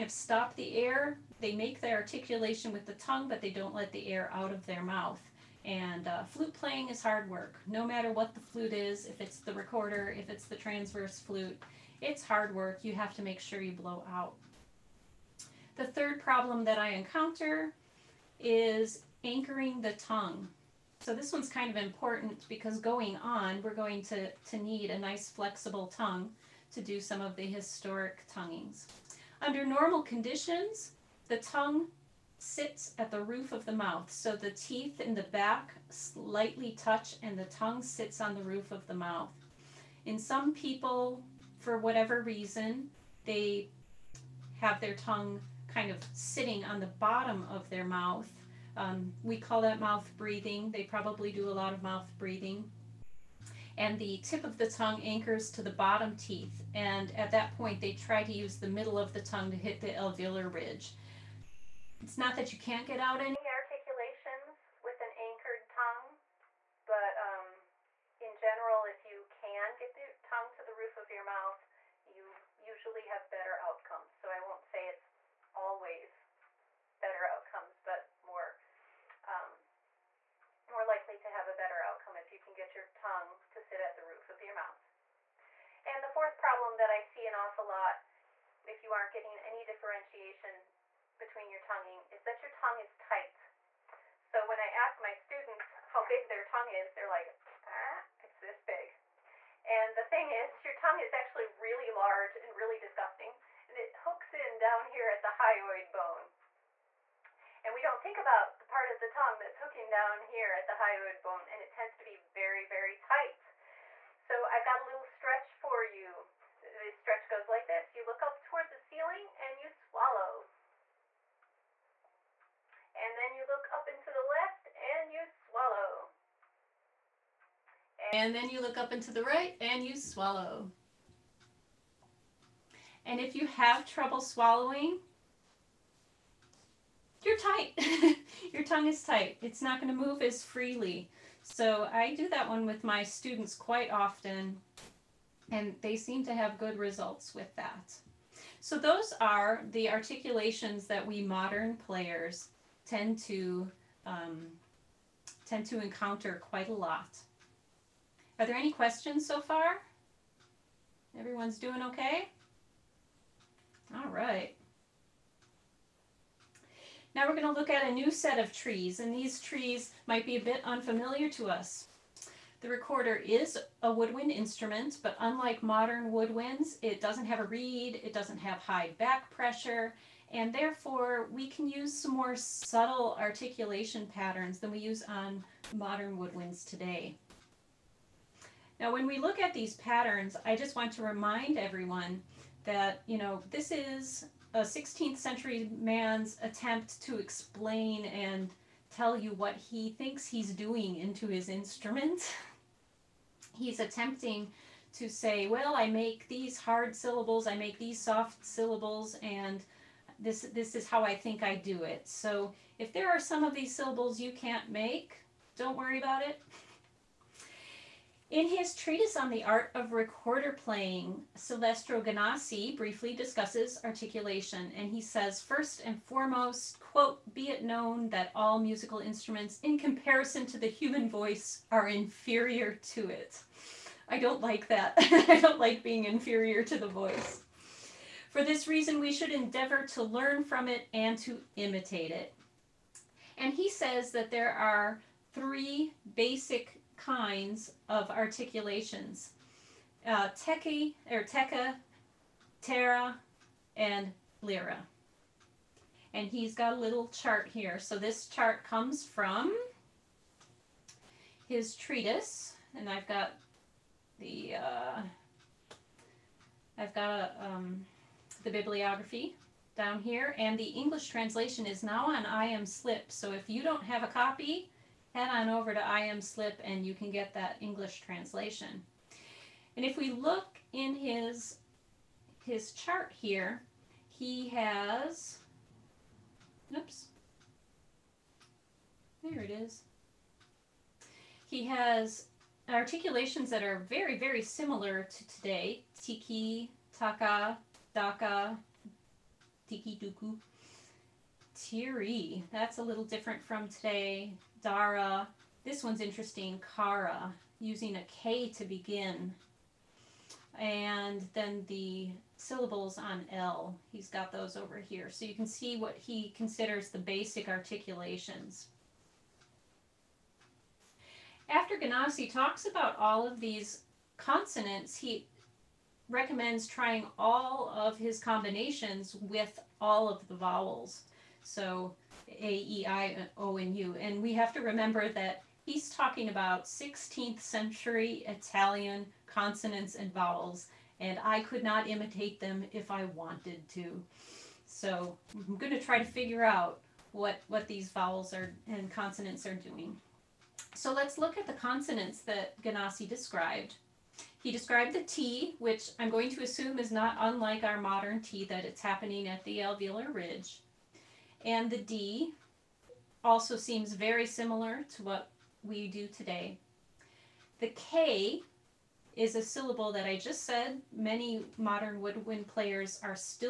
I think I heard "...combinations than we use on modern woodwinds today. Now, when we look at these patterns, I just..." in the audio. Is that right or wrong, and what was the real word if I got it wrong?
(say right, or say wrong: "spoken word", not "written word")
wrong: "patterns", not "combinations".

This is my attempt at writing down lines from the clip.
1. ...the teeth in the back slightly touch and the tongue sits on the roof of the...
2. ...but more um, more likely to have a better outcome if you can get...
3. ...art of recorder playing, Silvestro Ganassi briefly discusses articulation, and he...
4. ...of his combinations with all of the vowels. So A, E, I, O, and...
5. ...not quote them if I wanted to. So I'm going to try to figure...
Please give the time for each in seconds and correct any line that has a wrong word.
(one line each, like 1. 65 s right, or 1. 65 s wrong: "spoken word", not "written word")
1. 34 s right
2. 77 s right
3. 219 s right
4. 327 s right
5. 341 s wrong: "imitate", not "quote".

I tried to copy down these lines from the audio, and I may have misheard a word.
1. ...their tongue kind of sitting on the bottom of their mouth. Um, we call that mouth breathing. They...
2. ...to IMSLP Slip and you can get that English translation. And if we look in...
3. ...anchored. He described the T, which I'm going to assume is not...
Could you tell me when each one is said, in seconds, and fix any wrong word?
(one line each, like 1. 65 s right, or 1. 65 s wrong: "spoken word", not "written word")
1. 44 s right
2. 275 s right
3. 353 s wrong: "described", not "anchored".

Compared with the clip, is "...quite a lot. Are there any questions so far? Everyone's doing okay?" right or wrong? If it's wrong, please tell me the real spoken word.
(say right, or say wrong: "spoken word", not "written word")
right.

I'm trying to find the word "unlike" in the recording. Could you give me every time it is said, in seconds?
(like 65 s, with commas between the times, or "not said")
175 s, 357 s.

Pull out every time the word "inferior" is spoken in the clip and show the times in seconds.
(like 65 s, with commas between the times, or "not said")
231 s, 236 s.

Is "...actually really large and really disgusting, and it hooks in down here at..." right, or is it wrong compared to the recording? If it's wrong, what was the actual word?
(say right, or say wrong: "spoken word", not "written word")
right.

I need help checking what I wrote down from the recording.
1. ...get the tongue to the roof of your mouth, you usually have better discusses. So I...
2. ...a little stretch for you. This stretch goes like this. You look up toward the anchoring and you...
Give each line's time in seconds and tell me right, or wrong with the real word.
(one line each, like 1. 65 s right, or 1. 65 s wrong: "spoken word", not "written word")
1. 69 s wrong: "outcomes", not "discusses"
2. 114 s wrong: "ceiling", not "anchoring".